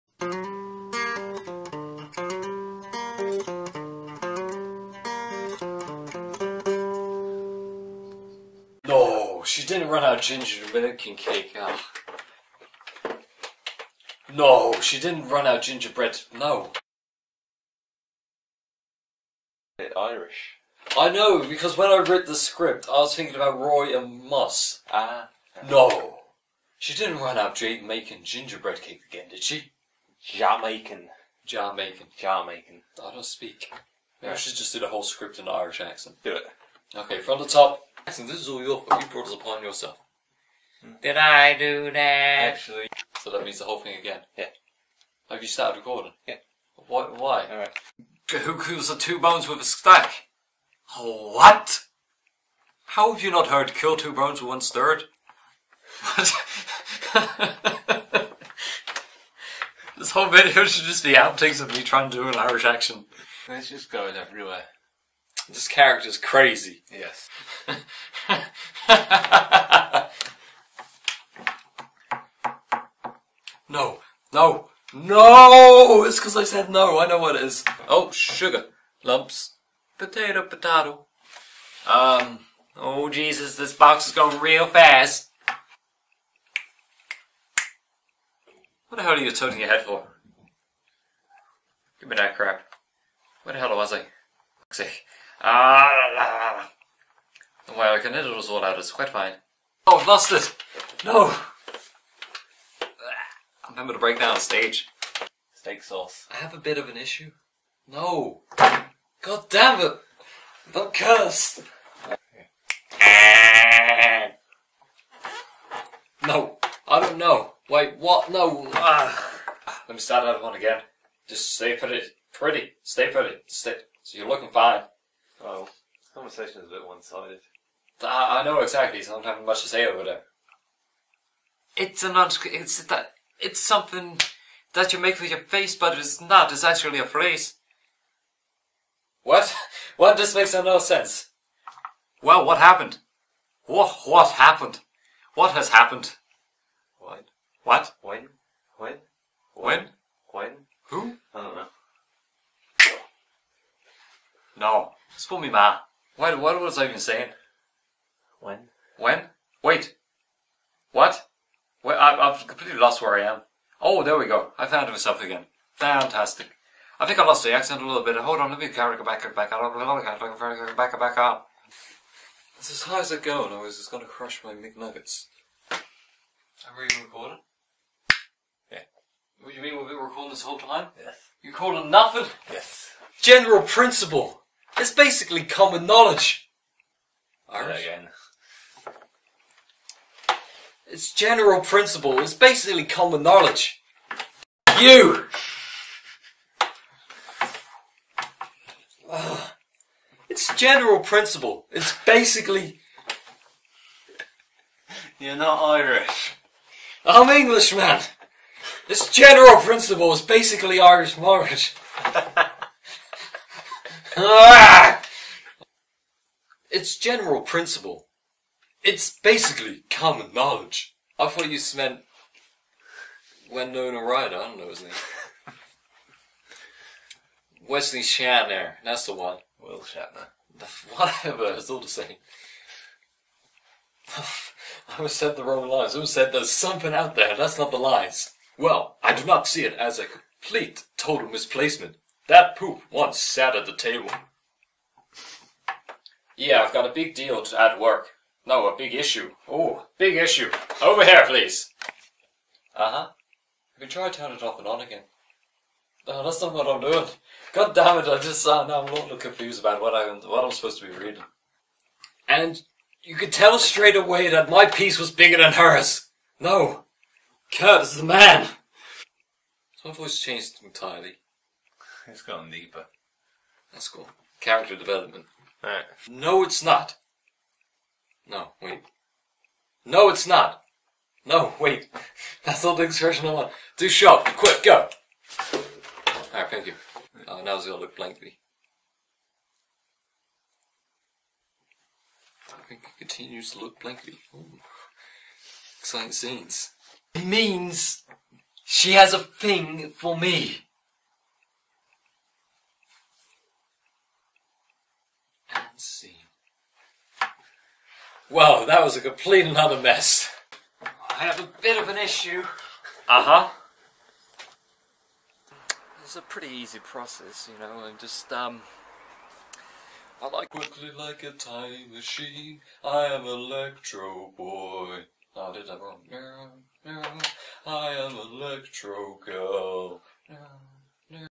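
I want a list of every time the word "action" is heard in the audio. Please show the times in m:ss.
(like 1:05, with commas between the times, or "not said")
1:02.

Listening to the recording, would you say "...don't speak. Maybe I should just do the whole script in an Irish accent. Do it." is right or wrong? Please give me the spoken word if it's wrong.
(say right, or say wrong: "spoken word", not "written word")
right.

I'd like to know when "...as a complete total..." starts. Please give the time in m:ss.
3:59.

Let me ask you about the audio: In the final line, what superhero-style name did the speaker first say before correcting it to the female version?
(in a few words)
Electro Boy.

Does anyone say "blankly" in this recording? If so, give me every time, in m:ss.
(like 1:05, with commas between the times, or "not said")
4:47, 4:53.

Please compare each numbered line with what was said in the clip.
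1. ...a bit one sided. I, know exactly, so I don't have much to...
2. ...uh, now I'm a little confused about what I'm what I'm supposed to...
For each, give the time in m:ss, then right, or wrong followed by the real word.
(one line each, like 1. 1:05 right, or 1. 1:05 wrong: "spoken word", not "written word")
1. 2:06 right
2. 4:18 right.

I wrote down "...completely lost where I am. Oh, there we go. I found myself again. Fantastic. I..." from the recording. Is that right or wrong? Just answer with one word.
right.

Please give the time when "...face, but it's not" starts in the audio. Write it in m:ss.
2:15.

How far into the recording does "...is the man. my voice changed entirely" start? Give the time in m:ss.
4:27.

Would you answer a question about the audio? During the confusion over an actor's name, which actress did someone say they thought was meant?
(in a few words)
Winona Ryder.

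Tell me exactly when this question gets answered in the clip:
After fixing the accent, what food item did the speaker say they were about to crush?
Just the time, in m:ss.
2:54.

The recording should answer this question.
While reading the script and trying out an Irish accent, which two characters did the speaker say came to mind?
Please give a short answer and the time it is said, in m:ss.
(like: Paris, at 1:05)
Roy and Moss, at 0:23.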